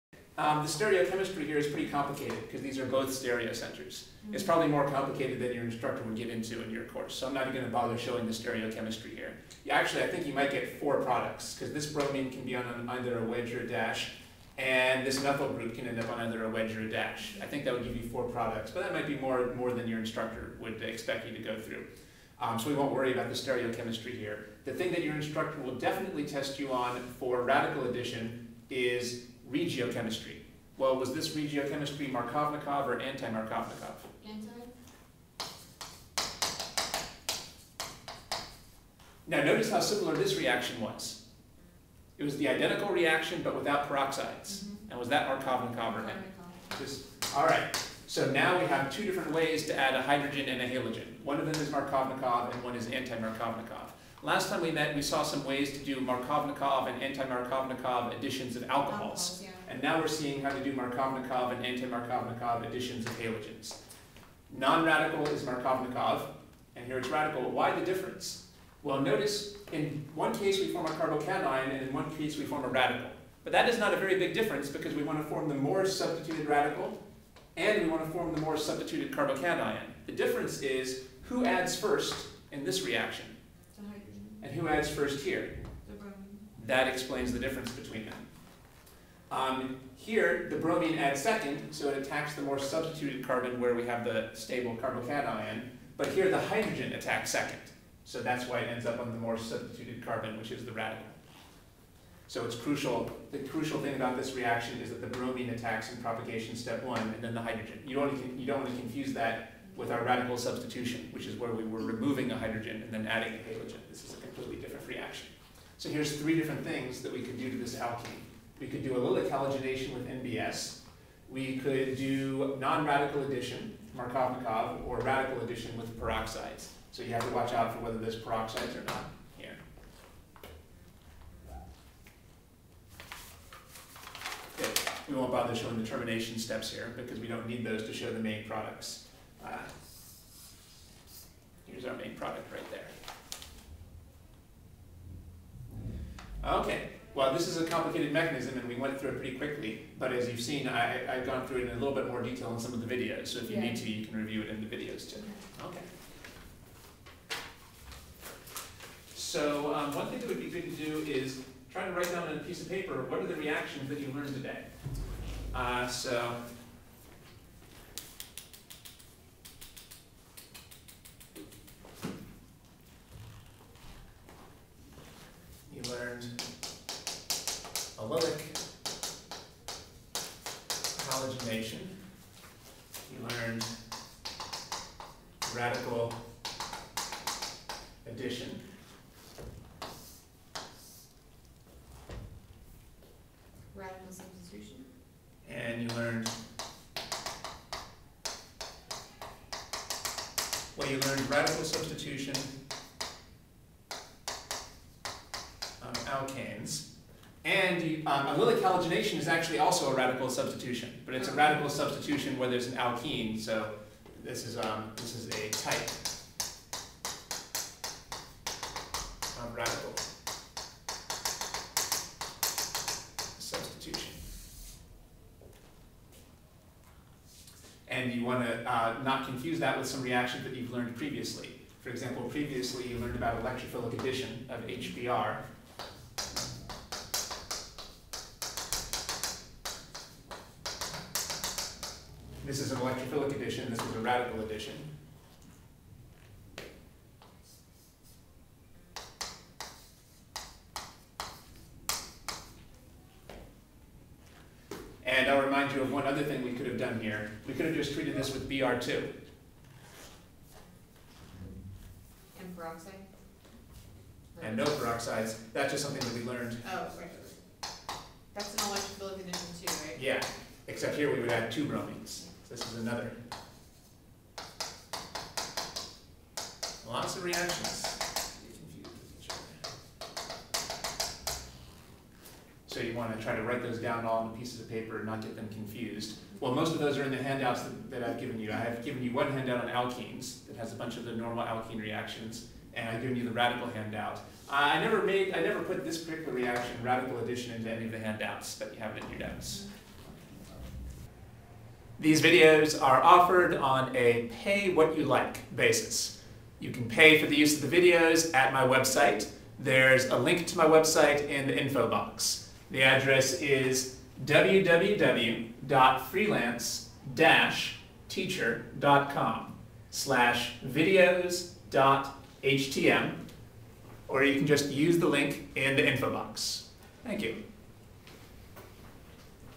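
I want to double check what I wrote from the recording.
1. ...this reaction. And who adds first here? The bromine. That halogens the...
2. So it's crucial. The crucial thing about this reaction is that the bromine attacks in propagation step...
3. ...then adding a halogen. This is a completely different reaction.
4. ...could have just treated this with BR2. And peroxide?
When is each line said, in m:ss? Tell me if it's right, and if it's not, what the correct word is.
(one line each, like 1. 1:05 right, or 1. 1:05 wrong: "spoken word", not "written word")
1. 1:22 wrong: "explains", not "halogens"
2. 1:42 right
3. 1:52 right
4. 4:17 right.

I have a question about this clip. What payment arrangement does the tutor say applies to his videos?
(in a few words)
Pay what you like.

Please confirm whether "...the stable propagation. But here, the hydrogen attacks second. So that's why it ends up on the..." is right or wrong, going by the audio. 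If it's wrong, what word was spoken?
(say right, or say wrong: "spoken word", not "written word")
wrong: "carbocation", not "propagation".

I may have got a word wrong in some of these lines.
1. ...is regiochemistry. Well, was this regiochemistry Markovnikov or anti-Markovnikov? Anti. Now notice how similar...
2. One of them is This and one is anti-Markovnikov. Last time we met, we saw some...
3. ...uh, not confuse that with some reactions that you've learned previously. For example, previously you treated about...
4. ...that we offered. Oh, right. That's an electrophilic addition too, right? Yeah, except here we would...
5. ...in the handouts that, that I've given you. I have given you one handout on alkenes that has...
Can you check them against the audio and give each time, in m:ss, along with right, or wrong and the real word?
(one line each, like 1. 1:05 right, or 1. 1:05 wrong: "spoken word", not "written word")
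1. 0:28 right
2. 0:51 wrong: "Markovnikov", not "This"
3. 3:48 wrong: "learned", not "treated"
4. 4:26 wrong: "learned", not "offered"
5. 4:47 right.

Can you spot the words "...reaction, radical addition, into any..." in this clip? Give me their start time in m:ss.
4:56.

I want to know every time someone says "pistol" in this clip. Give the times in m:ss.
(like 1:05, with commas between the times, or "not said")
not said.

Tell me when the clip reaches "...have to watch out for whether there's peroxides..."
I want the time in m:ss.
2:07.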